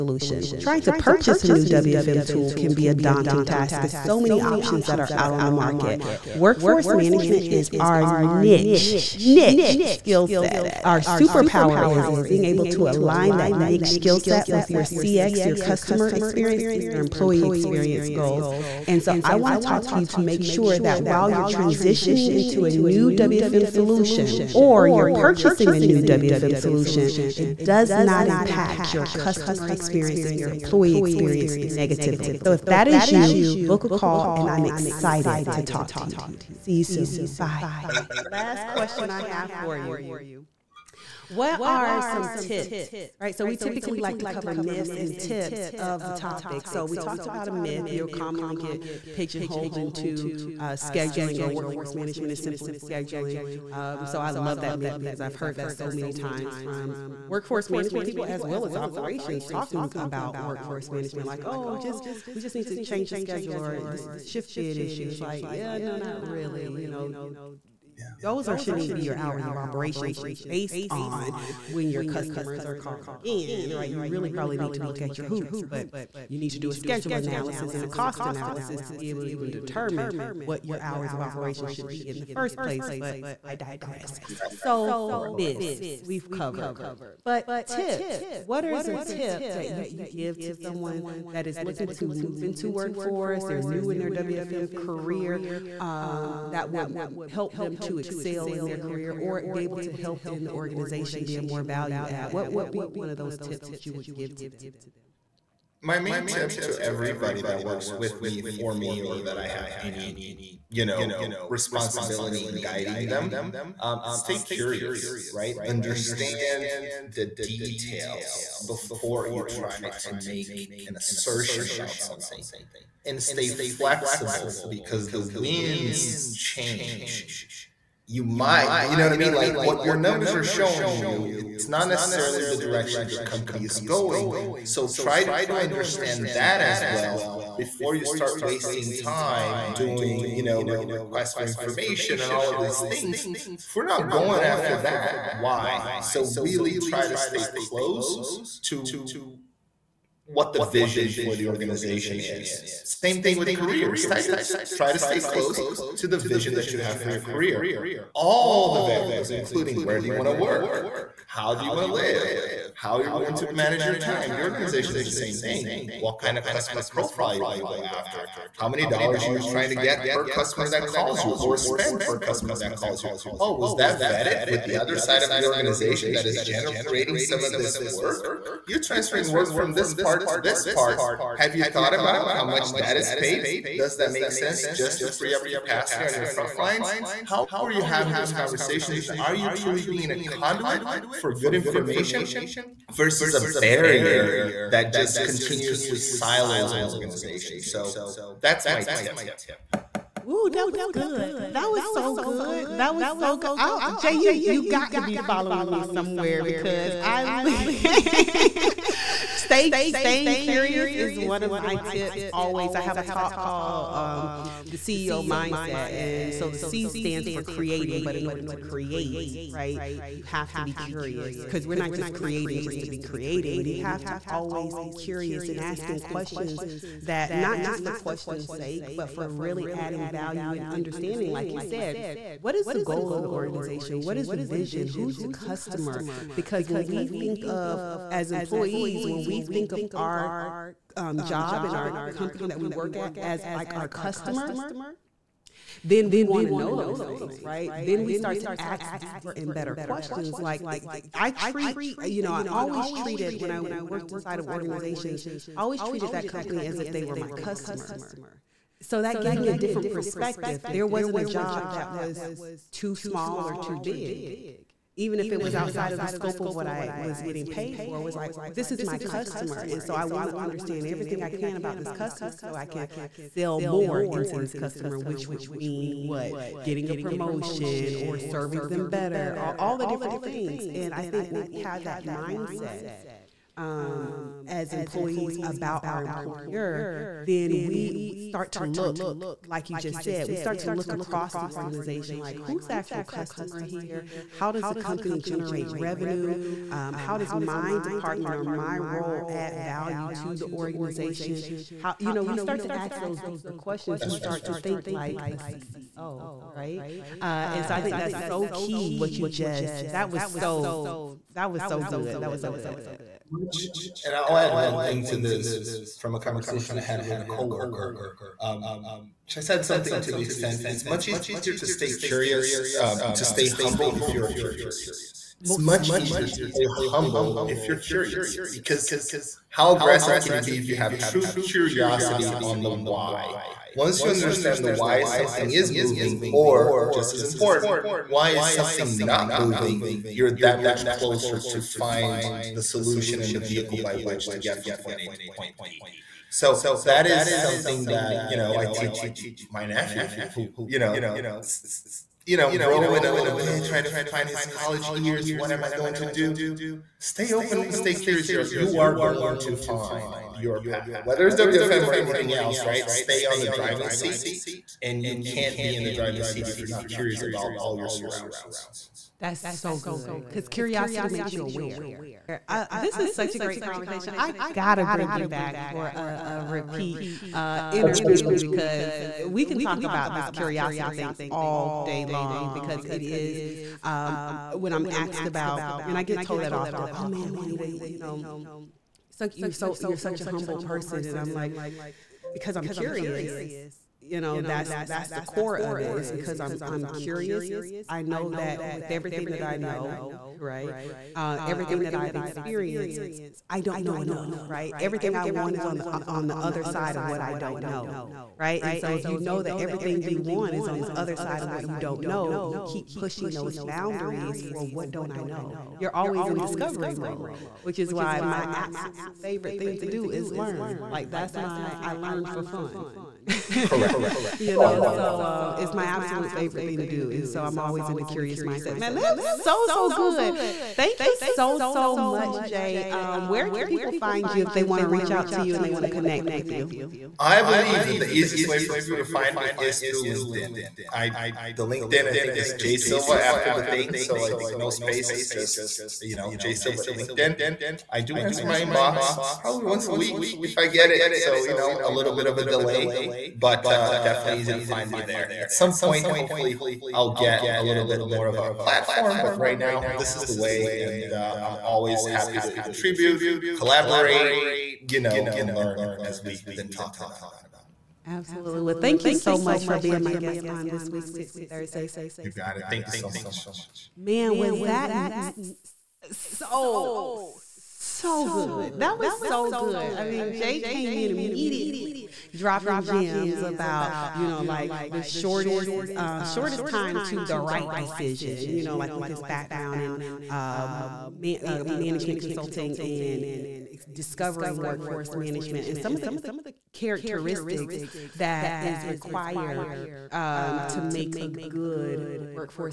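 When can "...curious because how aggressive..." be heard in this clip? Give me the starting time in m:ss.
5:27.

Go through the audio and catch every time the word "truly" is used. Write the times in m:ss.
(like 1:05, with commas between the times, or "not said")
3:09.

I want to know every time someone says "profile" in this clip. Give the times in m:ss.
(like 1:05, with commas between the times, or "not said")
2:46.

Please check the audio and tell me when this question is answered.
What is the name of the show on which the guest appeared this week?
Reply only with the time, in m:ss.
7:51.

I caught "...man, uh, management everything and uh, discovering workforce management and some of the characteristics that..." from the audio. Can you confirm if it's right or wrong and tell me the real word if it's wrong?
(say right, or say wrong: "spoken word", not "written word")
wrong: "consulting", not "everything".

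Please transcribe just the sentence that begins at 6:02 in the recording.
Stay on the driving seat, and you can't be in the driving seat if you're not curious about all your surroundings.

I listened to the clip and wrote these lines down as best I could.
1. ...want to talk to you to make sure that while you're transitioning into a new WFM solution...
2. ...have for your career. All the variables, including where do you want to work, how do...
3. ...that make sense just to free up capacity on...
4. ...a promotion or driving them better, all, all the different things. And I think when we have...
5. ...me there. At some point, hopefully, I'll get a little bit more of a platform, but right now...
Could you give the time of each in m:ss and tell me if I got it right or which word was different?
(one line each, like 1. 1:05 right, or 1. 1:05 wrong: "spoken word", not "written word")
1. 0:19 right
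2. 2:36 right
3. 3:03 right
4. 4:36 wrong: "serving", not "driving"
5. 7:34 right.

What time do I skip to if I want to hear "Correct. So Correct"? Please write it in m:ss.
1:24.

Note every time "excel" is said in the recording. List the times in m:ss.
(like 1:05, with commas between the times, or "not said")
1:37.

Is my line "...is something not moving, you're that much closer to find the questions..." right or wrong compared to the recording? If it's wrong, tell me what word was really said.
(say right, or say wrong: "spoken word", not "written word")
wrong: "solution", not "questions".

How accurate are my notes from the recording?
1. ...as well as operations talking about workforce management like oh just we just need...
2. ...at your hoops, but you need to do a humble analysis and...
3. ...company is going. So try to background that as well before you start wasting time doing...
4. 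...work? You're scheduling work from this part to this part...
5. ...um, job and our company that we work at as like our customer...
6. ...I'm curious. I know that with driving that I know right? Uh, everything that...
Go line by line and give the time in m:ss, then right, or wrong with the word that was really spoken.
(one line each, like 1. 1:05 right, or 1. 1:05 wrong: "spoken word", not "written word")
1. 0:58 right
2. 1:15 wrong: "schedule", not "humble"
3. 2:13 wrong: "understand", not "background"
4. 2:57 wrong: "transferring", not "scheduling"
5. 4:00 right
6. 6:36 wrong: "everything", not "driving".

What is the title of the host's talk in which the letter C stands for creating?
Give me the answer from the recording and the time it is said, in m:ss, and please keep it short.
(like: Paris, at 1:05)
The CEO Mindset, at 3:34.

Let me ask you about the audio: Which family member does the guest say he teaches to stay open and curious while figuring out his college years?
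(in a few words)
Nephew.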